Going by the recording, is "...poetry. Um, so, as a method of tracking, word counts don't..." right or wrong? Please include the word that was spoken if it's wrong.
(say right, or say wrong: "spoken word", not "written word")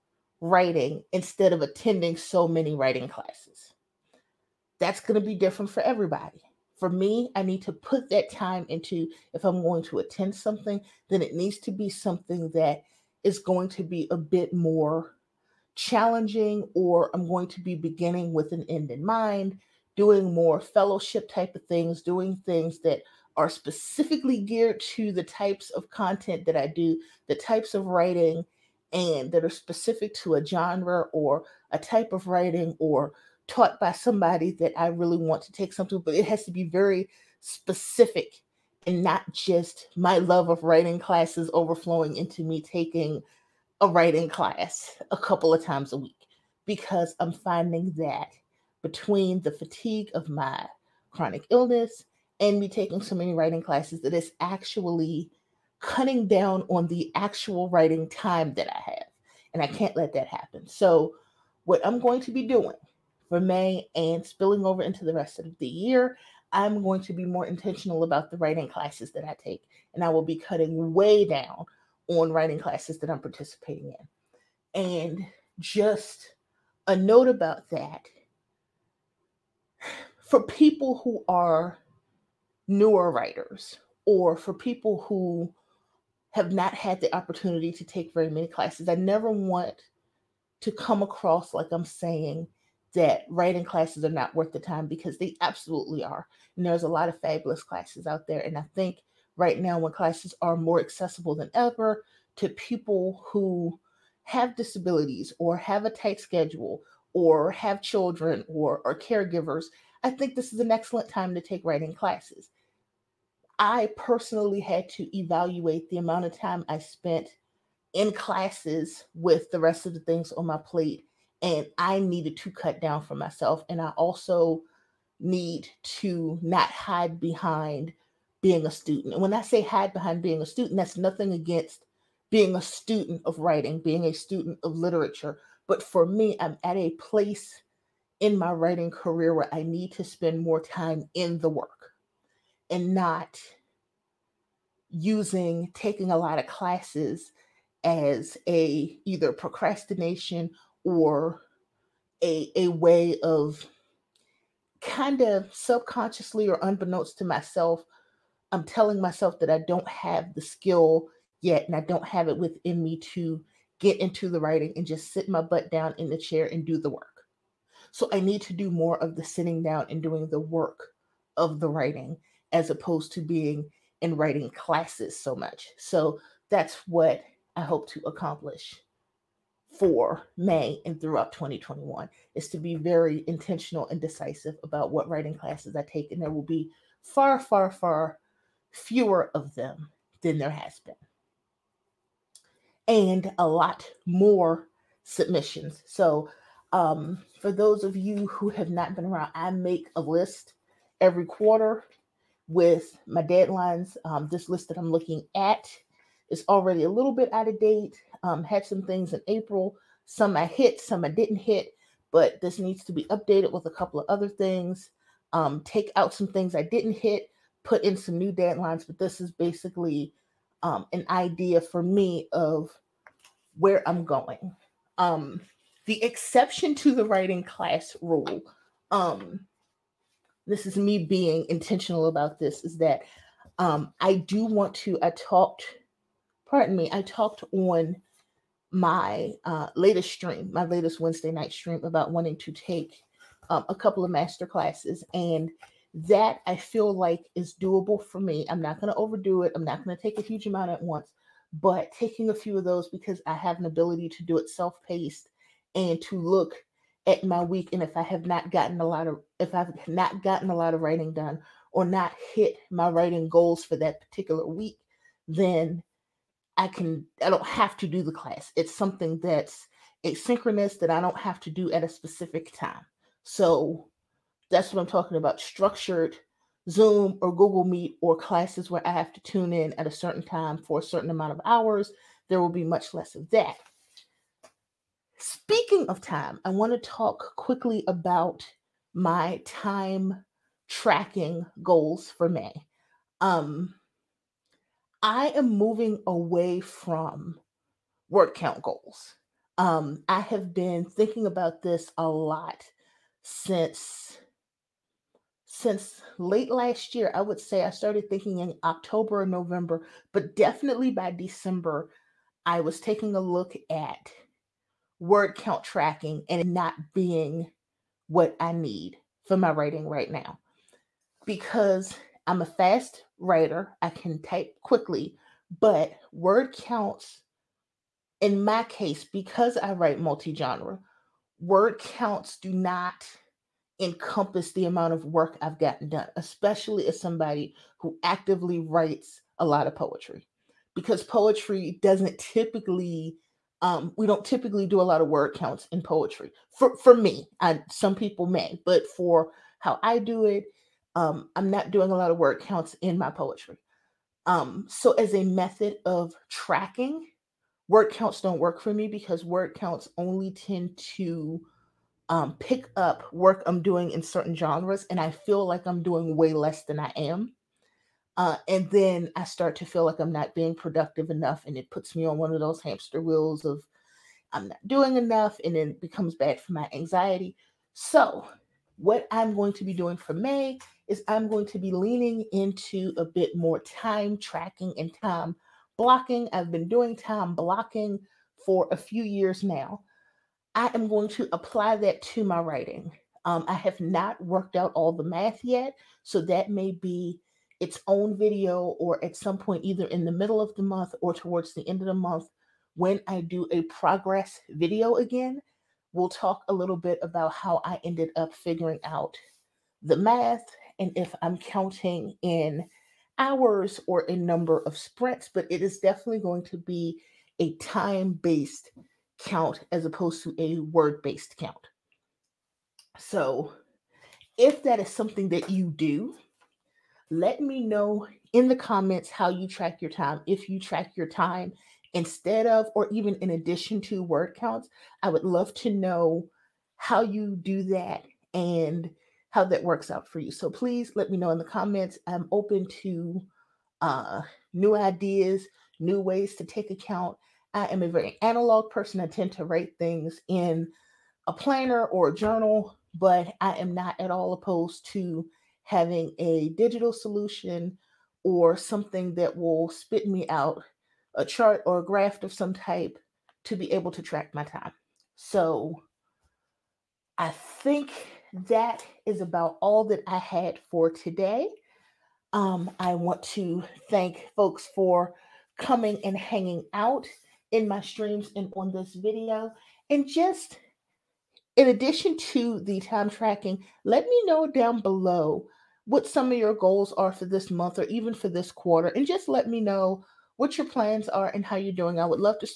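right.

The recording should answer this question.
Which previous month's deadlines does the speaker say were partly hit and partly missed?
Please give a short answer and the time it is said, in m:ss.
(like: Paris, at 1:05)
April, at 3:29.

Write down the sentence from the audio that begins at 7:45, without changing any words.
So I think that is about all that I had for today.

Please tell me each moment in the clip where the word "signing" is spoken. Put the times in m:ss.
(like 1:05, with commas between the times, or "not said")
not said.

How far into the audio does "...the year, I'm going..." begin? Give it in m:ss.
1:05.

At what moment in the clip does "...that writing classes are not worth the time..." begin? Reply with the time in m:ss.
1:32.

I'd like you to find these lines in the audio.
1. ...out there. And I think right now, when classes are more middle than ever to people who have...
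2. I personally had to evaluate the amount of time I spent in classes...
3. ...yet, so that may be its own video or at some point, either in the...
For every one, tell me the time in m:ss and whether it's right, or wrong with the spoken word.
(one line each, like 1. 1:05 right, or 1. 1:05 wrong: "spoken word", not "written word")
1. 1:38 wrong: "accessible", not "middle"
2. 1:53 right
3. 6:35 right.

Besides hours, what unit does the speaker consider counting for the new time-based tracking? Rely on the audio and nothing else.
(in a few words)
sprints.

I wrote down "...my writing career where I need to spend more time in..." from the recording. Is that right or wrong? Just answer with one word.
right.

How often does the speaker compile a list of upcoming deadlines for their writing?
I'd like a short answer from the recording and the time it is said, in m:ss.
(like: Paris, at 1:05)
every quarter, at 3:21.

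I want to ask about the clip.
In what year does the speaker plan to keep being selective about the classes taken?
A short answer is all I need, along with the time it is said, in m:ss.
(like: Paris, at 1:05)
2021, at 3:01.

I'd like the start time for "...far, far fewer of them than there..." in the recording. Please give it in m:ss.
3:07.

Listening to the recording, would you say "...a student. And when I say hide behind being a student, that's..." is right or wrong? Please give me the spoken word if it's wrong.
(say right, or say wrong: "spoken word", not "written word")
right.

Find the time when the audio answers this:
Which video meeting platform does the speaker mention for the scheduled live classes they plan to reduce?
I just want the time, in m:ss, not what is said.
4:37.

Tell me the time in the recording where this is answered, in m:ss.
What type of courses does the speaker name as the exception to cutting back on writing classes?
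4:04.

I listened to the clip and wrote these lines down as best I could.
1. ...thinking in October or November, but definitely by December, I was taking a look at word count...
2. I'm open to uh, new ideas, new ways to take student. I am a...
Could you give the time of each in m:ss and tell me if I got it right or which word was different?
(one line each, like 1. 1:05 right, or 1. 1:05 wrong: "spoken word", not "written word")
1. 5:08 right
2. 7:22 wrong: "account", not "student".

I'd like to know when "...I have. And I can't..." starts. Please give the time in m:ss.
0:58.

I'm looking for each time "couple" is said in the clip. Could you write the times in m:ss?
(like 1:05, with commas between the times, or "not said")
0:45, 3:33, 4:03.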